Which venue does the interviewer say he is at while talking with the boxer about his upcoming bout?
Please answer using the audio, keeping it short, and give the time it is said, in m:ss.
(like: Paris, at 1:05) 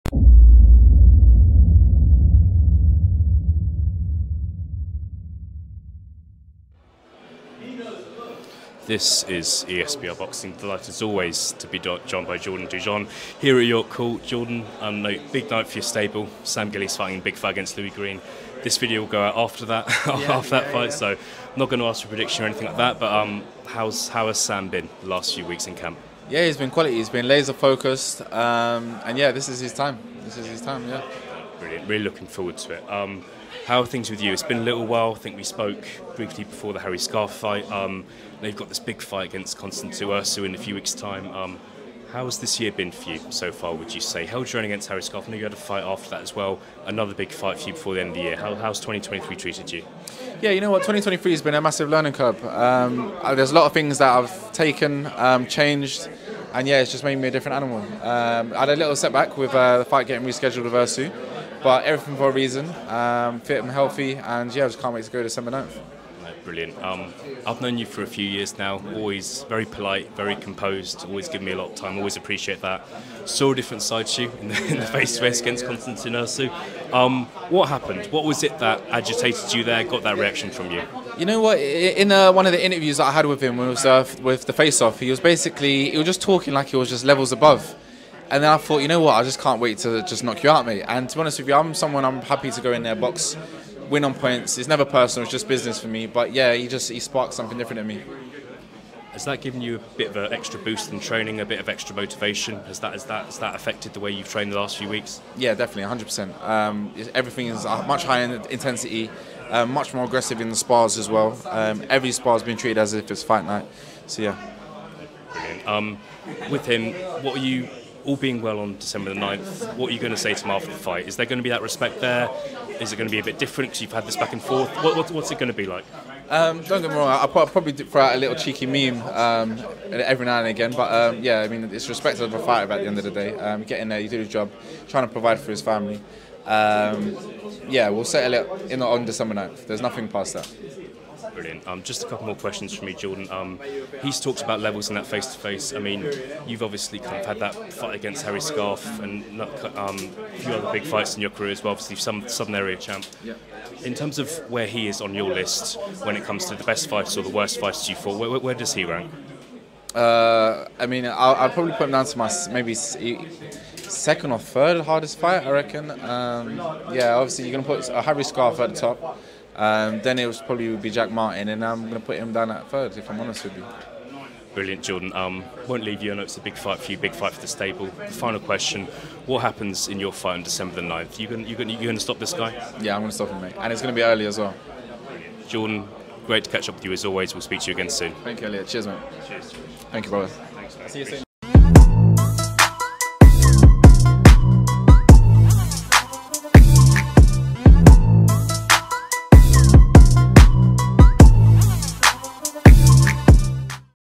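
York Court, at 0:13.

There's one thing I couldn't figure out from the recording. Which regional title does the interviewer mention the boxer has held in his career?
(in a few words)
Southern area champ.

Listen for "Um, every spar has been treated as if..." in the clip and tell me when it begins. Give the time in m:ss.
1:51.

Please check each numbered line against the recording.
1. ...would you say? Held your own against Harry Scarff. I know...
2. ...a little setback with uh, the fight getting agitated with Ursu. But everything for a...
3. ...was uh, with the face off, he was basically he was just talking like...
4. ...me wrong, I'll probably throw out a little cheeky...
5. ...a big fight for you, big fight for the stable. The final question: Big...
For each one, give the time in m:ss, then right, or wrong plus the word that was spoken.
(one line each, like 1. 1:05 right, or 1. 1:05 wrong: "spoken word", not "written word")
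1. 0:43 right
2. 0:58 wrong: "rescheduled", not "agitated"
3. 1:23 right
4. 2:06 right
5. 2:56 wrong: "What", not "Big".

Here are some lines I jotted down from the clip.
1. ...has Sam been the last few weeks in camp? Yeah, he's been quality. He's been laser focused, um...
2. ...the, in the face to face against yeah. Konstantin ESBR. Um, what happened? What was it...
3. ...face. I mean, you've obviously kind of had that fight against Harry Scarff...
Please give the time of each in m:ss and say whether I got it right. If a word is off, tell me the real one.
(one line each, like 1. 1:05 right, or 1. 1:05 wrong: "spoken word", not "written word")
1. 0:24 right
2. 1:14 wrong: "Ursu", not "ESBR"
3. 2:25 right.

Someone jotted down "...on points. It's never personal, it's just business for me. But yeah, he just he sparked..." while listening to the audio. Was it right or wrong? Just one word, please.
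right.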